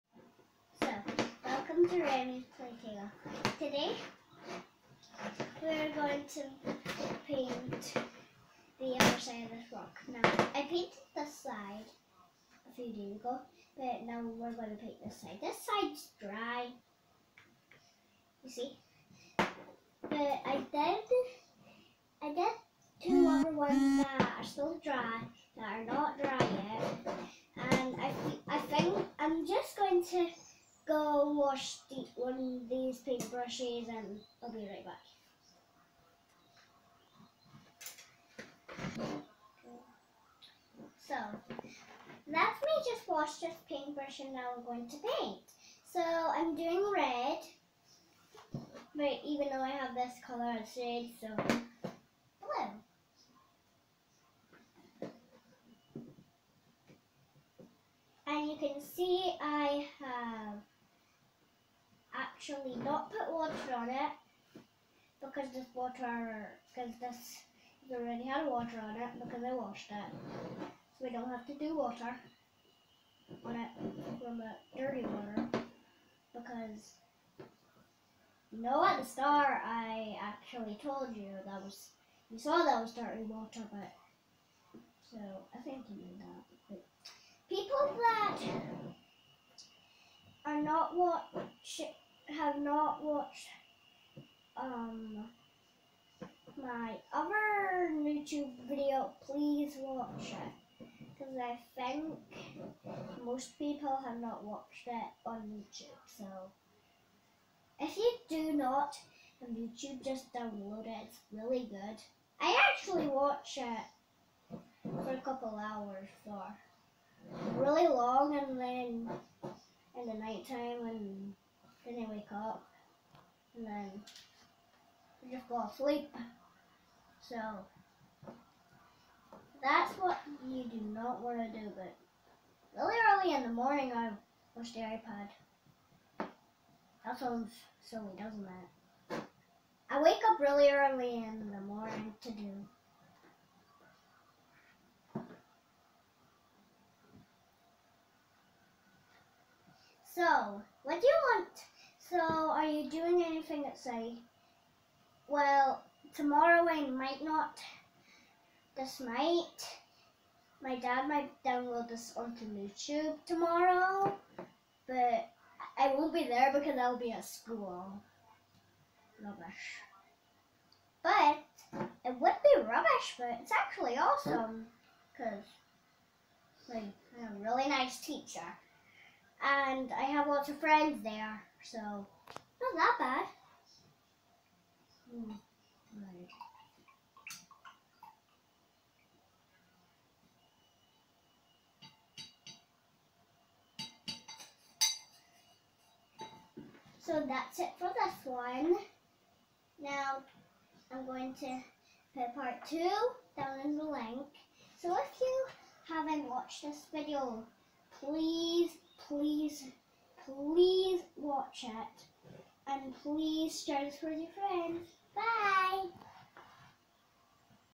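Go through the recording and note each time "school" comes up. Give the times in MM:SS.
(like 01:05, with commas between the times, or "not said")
02:47.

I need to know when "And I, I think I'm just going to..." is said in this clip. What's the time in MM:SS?
00:27.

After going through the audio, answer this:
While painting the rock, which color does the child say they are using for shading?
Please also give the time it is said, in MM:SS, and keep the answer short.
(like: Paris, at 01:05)
blue, at 00:51.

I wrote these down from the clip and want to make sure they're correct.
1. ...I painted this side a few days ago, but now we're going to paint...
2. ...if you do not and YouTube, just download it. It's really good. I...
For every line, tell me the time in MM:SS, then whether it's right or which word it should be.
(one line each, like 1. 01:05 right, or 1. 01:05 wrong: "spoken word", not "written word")
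1. 00:10 right
2. 01:47 right.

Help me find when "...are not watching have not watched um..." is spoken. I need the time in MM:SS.
01:30.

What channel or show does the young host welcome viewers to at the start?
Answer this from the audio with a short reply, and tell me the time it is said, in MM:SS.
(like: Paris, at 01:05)
Remy's Playtale, at 00:02.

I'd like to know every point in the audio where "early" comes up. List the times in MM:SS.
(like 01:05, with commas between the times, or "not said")
02:13, 02:20.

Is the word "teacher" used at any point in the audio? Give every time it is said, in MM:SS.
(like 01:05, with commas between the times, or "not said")
02:58.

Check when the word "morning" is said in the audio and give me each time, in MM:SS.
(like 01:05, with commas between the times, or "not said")
02:13, 02:21.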